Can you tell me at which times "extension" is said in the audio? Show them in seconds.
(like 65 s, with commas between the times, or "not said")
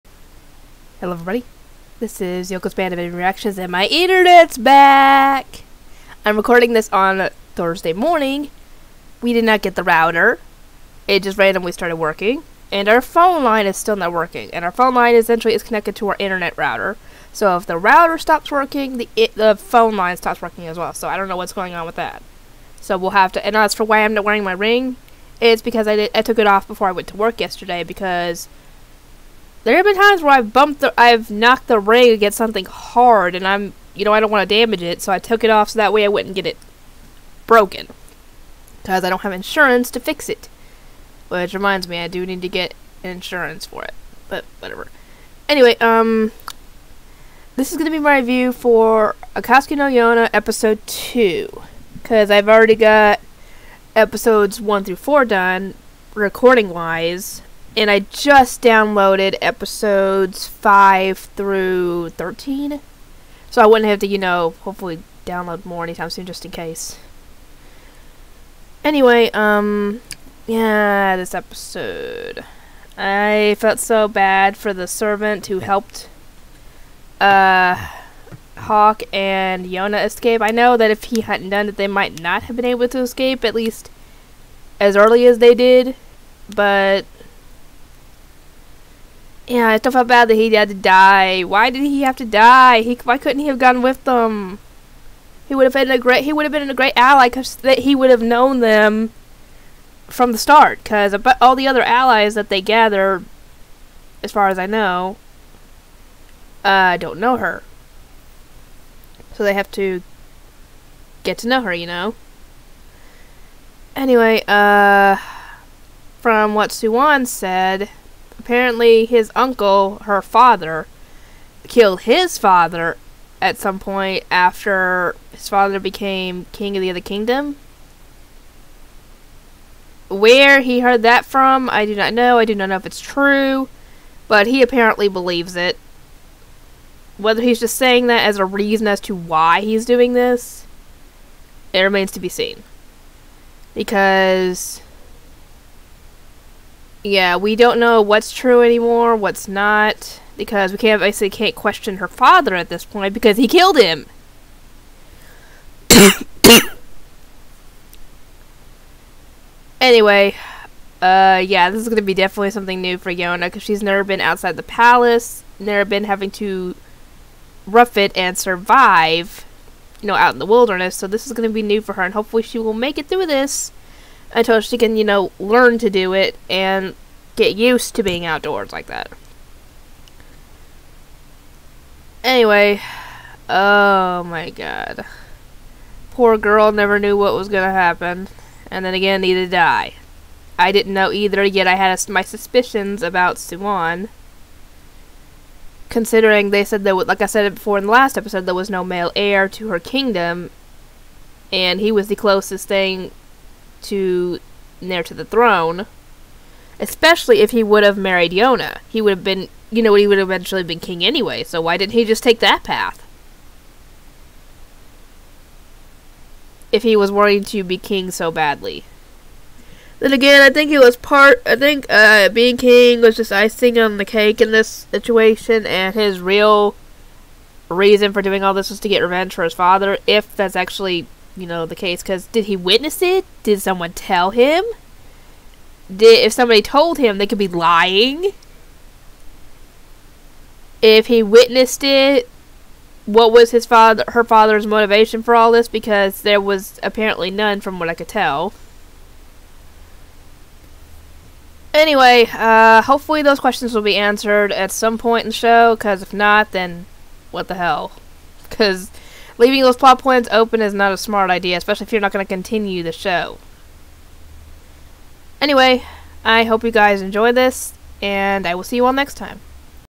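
not said.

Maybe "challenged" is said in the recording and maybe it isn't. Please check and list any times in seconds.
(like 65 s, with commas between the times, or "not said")
not said.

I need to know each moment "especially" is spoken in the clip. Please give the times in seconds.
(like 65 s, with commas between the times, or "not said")
206 s, 261 s.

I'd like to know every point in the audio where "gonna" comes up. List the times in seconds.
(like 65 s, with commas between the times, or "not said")
161 s, 171 s.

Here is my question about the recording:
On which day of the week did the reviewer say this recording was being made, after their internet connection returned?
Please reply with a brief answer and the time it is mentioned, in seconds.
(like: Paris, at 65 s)
Thursday, at 7 s.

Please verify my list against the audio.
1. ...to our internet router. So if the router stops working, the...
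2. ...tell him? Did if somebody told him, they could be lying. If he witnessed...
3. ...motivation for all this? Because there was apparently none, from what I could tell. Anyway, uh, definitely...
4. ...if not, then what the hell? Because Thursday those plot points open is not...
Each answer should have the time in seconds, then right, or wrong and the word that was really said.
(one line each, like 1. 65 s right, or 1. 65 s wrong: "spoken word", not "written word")
1. 15 s right
2. 233 s right
3. 244 s wrong: "hopefully", not "definitely"
4. 256 s wrong: "Leaving", not "Thursday".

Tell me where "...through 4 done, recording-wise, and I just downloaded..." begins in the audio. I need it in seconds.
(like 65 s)
54 s.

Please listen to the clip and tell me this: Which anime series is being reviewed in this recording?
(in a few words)
Akatsuki no Yona.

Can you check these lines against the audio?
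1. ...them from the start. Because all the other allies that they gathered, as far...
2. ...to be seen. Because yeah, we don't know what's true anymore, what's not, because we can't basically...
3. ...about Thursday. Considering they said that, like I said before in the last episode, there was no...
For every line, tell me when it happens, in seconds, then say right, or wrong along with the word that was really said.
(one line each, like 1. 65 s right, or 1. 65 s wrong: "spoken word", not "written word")
1. 98 s right
2. 142 s right
3. 193 s wrong: "Suwon", not "Thursday".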